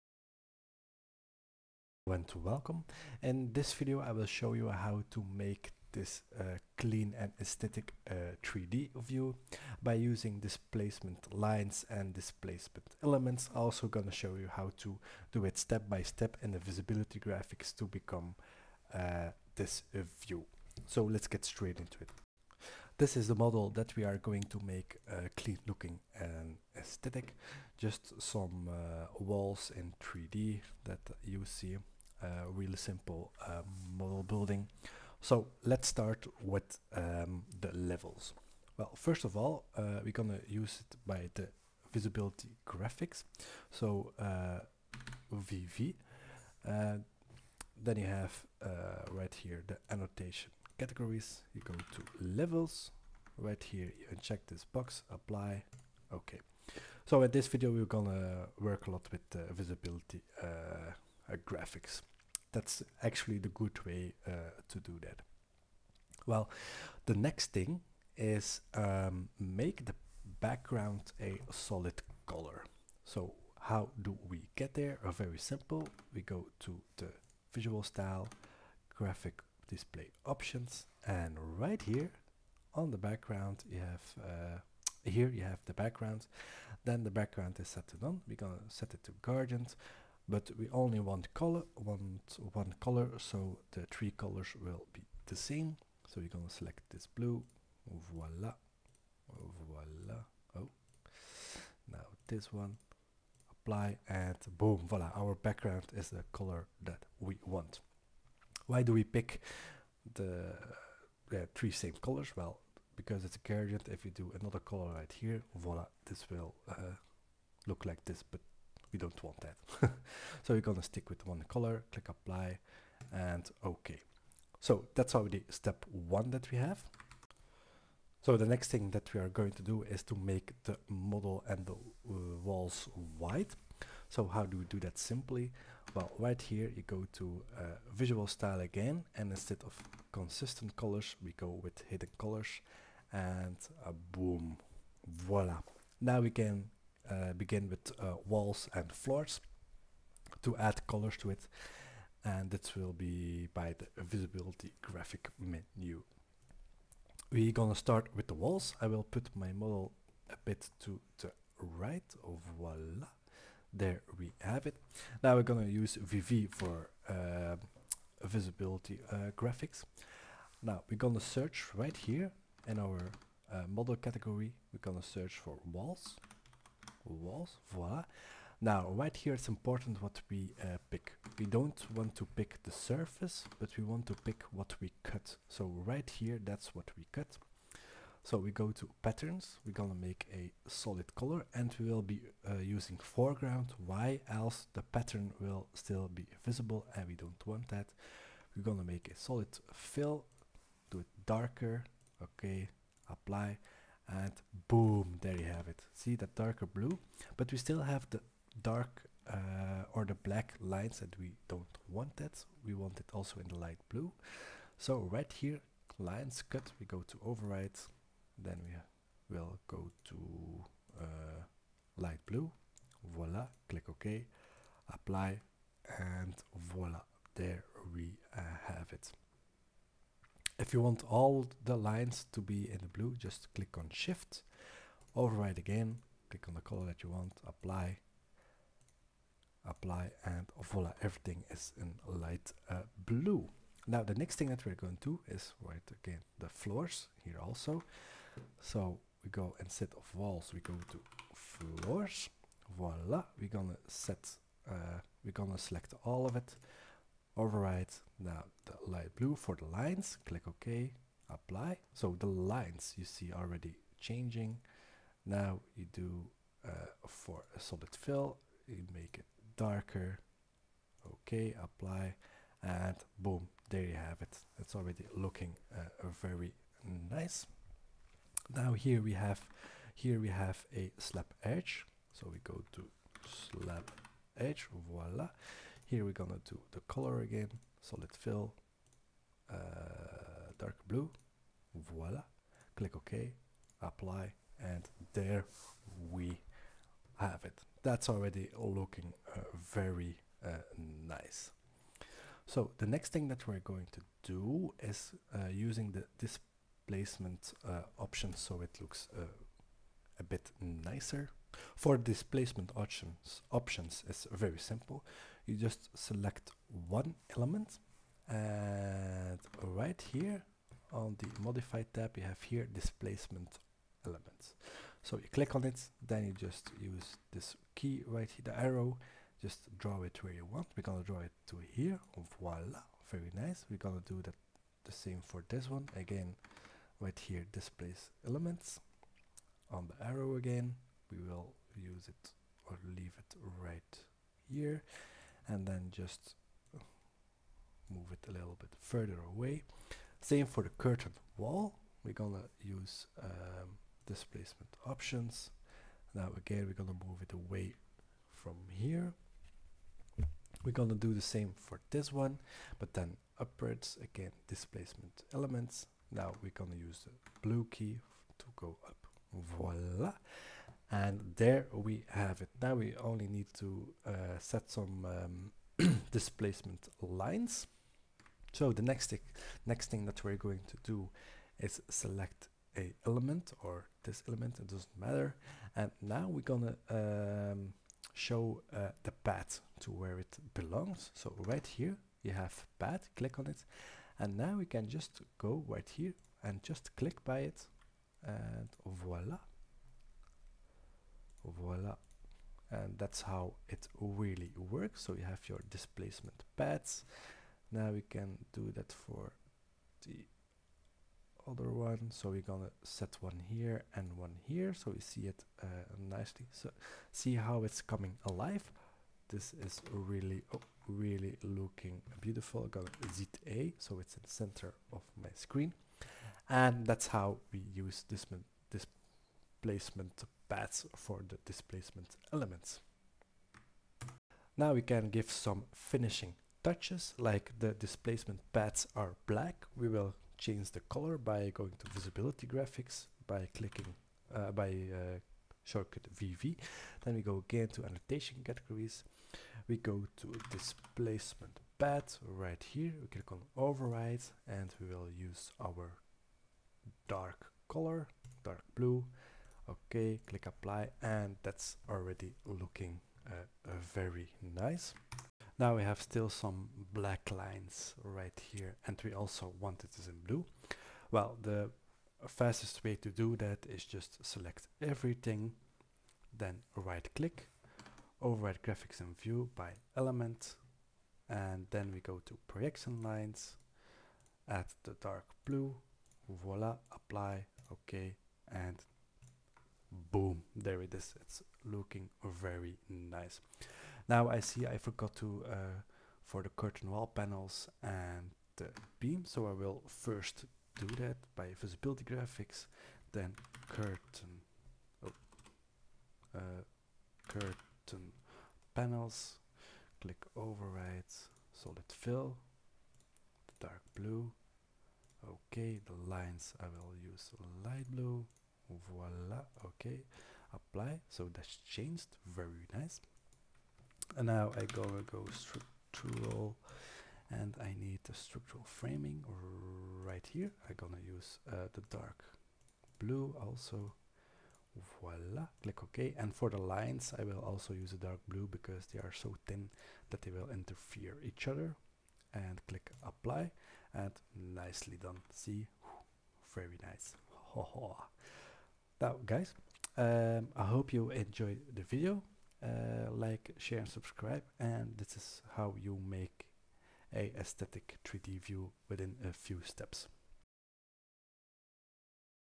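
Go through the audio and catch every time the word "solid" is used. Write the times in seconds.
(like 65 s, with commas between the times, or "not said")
71 s, 190 s, 199 s, 267 s, 287 s, 511 s.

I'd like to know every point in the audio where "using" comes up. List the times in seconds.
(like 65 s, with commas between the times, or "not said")
9 s, 192 s, 305 s.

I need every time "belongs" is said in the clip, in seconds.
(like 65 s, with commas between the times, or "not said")
390 s.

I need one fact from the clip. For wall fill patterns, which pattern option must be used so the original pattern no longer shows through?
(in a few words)
Foreground.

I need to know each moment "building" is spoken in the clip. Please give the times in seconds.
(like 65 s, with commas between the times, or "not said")
34 s.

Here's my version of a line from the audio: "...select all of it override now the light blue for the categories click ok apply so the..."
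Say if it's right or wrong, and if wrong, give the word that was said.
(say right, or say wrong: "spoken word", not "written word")
wrong: "lines", not "categories".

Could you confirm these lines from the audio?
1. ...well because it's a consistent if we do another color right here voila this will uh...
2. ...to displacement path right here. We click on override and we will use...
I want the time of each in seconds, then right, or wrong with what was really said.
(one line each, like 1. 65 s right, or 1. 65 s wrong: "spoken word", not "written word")
1. 112 s wrong: "gradient", not "consistent"
2. 450 s right.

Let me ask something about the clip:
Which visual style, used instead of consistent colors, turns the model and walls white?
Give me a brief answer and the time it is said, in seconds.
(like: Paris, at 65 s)
Hidden colors, at 141 s.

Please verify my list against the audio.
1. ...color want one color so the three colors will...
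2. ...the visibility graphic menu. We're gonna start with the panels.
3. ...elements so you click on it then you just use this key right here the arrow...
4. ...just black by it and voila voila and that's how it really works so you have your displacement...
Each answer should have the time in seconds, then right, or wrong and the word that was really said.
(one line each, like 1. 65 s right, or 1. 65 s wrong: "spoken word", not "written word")
1. 91 s right
2. 153 s wrong: "walls", not "panels"
3. 324 s right
4. 396 s wrong: "click", not "black".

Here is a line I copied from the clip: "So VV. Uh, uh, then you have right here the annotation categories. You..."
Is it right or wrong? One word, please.
right.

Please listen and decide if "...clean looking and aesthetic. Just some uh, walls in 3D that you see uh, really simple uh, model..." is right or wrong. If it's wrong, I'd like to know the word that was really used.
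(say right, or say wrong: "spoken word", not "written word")
right.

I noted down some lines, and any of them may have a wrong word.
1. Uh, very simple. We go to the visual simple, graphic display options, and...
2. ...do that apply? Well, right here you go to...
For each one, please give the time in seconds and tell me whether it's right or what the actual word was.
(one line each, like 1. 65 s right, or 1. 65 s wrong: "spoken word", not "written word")
1. 75 s wrong: "style", not "simple"
2. 134 s wrong: "simply", not "apply".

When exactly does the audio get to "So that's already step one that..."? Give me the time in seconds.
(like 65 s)
124 s.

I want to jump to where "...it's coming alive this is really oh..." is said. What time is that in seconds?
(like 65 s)
417 s.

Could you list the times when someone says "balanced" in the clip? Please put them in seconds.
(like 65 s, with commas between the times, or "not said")
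not said.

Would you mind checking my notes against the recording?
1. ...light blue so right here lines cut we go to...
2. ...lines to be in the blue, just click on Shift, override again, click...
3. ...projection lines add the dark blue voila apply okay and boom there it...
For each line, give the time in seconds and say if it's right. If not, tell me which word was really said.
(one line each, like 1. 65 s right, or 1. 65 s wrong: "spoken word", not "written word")
1. 213 s right
2. 231 s right
3. 482 s right.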